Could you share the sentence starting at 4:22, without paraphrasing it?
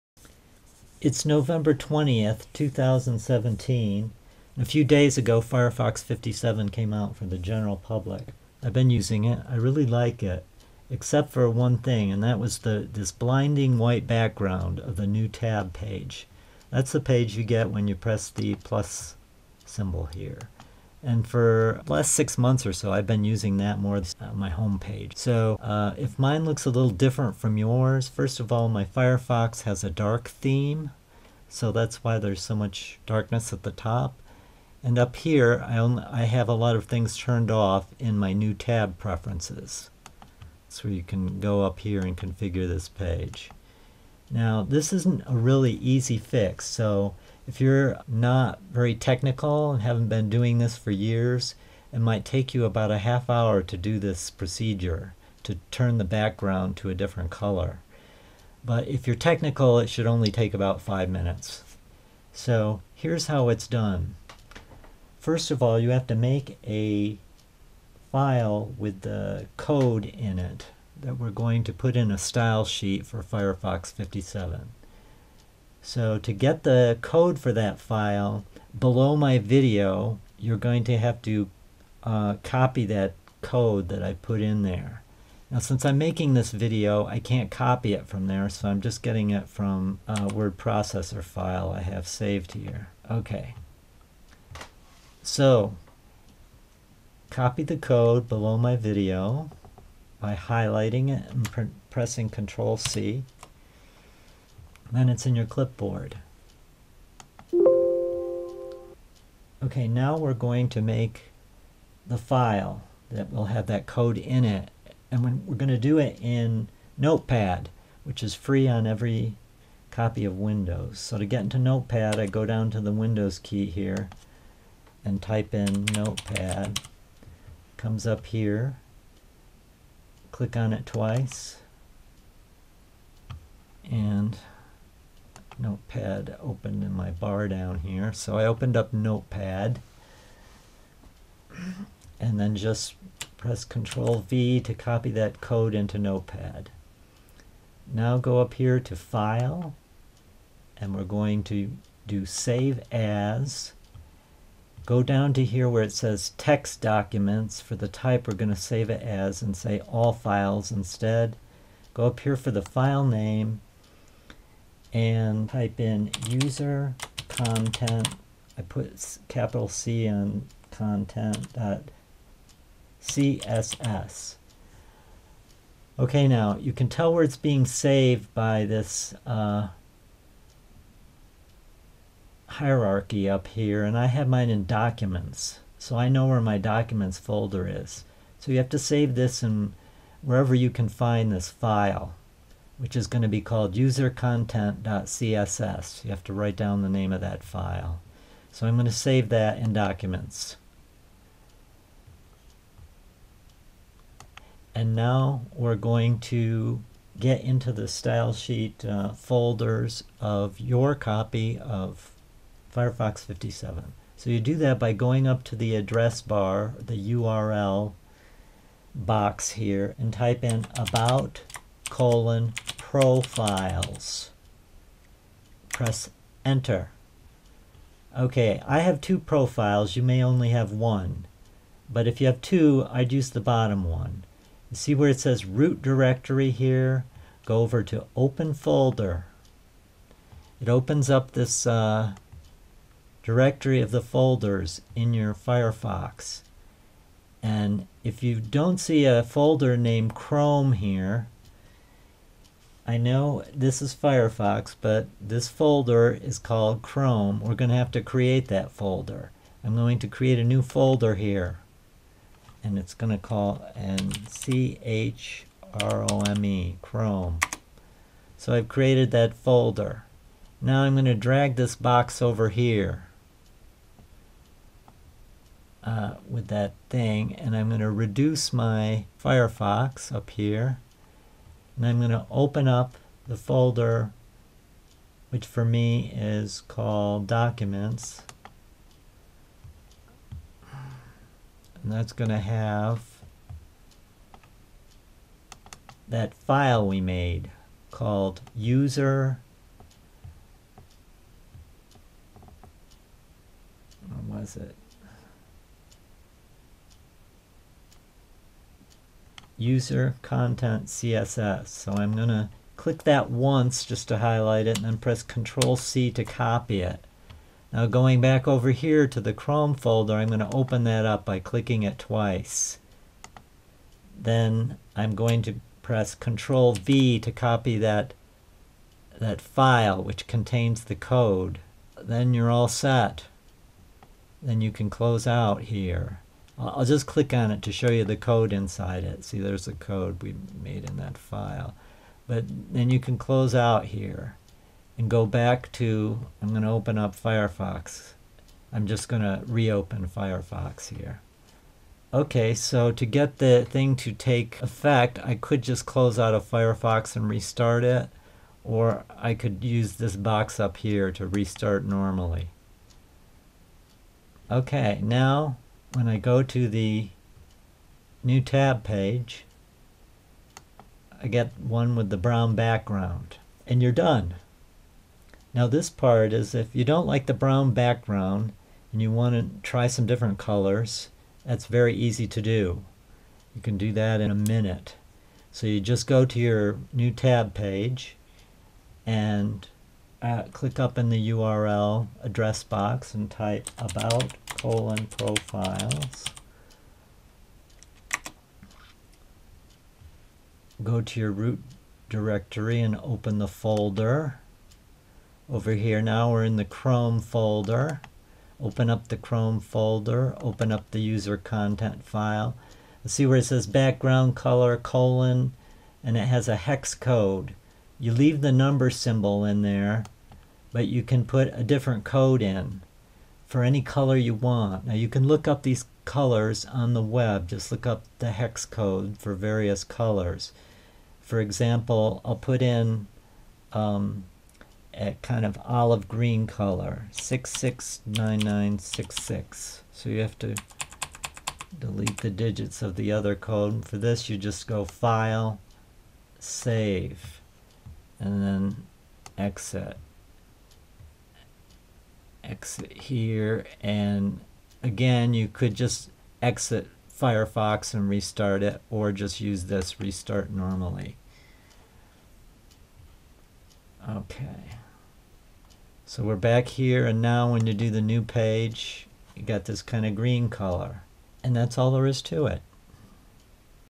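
And it's going to call and C-H-R-O-M-E, Chrome.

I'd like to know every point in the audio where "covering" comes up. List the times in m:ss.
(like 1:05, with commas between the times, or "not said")
not said.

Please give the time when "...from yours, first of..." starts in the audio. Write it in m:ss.
0:27.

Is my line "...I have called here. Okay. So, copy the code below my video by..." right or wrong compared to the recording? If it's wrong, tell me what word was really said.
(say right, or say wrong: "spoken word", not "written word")
wrong: "saved", not "called".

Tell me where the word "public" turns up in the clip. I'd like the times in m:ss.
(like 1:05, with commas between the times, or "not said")
0:07.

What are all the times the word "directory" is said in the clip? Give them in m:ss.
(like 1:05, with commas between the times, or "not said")
3:55, 4:03, 6:42.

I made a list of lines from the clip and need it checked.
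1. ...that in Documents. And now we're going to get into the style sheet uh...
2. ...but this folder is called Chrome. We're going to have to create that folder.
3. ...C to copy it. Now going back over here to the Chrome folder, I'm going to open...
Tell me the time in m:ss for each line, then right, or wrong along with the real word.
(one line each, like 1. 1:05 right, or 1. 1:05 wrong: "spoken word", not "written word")
1. 3:19 right
2. 4:14 right
3. 5:15 right.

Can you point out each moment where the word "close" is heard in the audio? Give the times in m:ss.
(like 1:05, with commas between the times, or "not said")
5:34, 5:43, 5:55.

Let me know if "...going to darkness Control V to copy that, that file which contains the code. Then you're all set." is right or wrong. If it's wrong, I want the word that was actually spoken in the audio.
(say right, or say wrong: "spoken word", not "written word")
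wrong: "press", not "darkness".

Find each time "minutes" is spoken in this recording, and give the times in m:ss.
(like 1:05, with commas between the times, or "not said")
1:01, 6:24.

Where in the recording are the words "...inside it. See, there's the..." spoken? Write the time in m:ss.
5:38.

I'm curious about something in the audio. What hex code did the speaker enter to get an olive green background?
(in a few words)
669966.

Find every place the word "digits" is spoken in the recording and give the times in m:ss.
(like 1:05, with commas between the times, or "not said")
7:22.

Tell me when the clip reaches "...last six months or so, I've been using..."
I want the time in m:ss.
0:21.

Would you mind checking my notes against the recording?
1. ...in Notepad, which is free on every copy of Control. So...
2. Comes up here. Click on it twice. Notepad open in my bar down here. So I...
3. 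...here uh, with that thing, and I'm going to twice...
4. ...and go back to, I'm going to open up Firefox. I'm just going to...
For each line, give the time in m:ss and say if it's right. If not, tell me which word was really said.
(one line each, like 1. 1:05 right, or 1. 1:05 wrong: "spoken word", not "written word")
1. 1:56 wrong: "Windows", not "Control"
2. 2:07 right
3. 4:32 wrong: "reduce", not "twice"
4. 5:44 right.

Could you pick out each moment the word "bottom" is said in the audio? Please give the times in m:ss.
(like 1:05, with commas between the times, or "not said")
3:53.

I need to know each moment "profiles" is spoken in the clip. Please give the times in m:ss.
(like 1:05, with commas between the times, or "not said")
3:42, 3:49, 6:35.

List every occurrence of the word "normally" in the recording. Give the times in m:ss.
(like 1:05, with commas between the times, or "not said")
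6:01, 7:40.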